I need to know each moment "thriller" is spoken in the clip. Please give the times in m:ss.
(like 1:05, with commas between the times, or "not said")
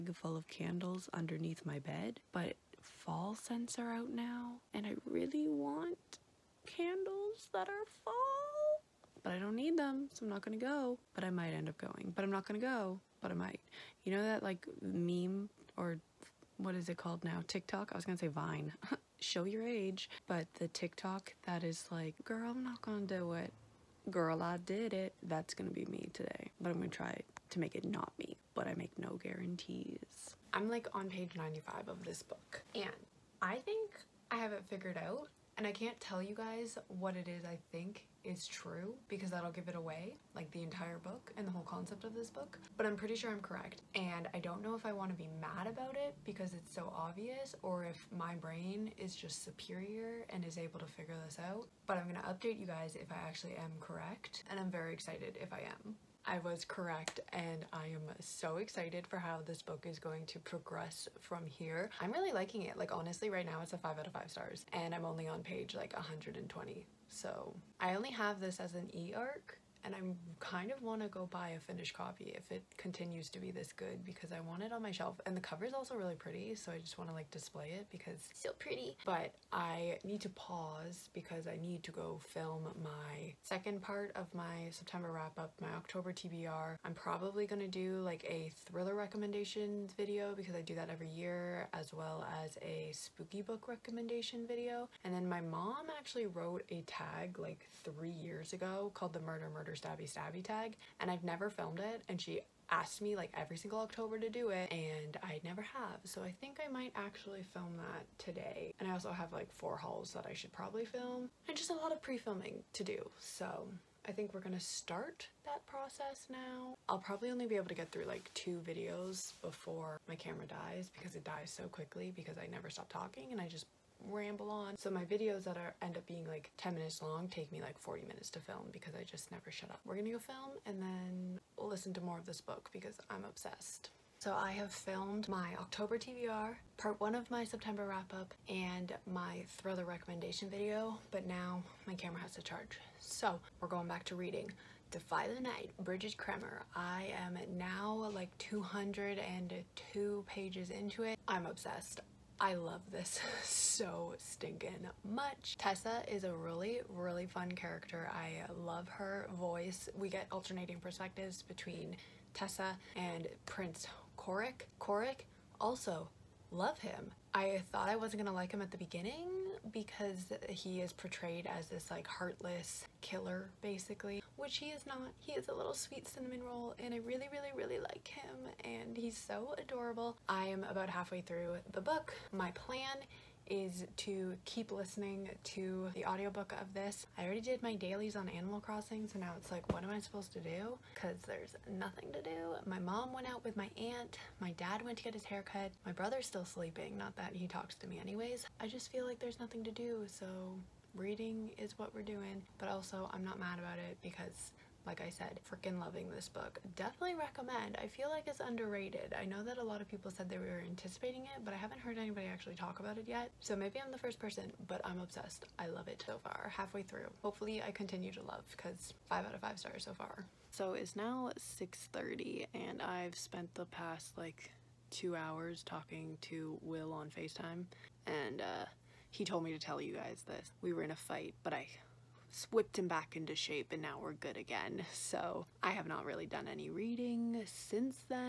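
1:28, 2:19.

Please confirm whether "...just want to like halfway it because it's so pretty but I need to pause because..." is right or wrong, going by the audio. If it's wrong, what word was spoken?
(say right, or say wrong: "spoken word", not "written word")
wrong: "display", not "halfway".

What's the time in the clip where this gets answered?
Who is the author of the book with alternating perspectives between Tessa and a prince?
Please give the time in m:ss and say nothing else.
2:25.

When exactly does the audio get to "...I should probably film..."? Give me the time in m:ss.
1:50.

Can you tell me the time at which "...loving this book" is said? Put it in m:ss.
3:25.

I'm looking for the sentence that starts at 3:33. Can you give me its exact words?
So maybe I'm the first person, but I'm obsessed.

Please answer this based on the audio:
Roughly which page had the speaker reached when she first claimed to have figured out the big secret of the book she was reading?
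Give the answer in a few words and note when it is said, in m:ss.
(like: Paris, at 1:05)
95, at 0:31.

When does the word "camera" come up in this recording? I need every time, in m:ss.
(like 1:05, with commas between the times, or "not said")
2:00, 2:21.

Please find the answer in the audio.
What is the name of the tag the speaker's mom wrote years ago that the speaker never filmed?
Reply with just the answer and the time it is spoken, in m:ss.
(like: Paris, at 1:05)
Murder Murder Your Stabby Stabby tag, at 1:39.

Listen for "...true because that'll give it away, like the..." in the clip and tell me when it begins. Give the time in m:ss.
0:38.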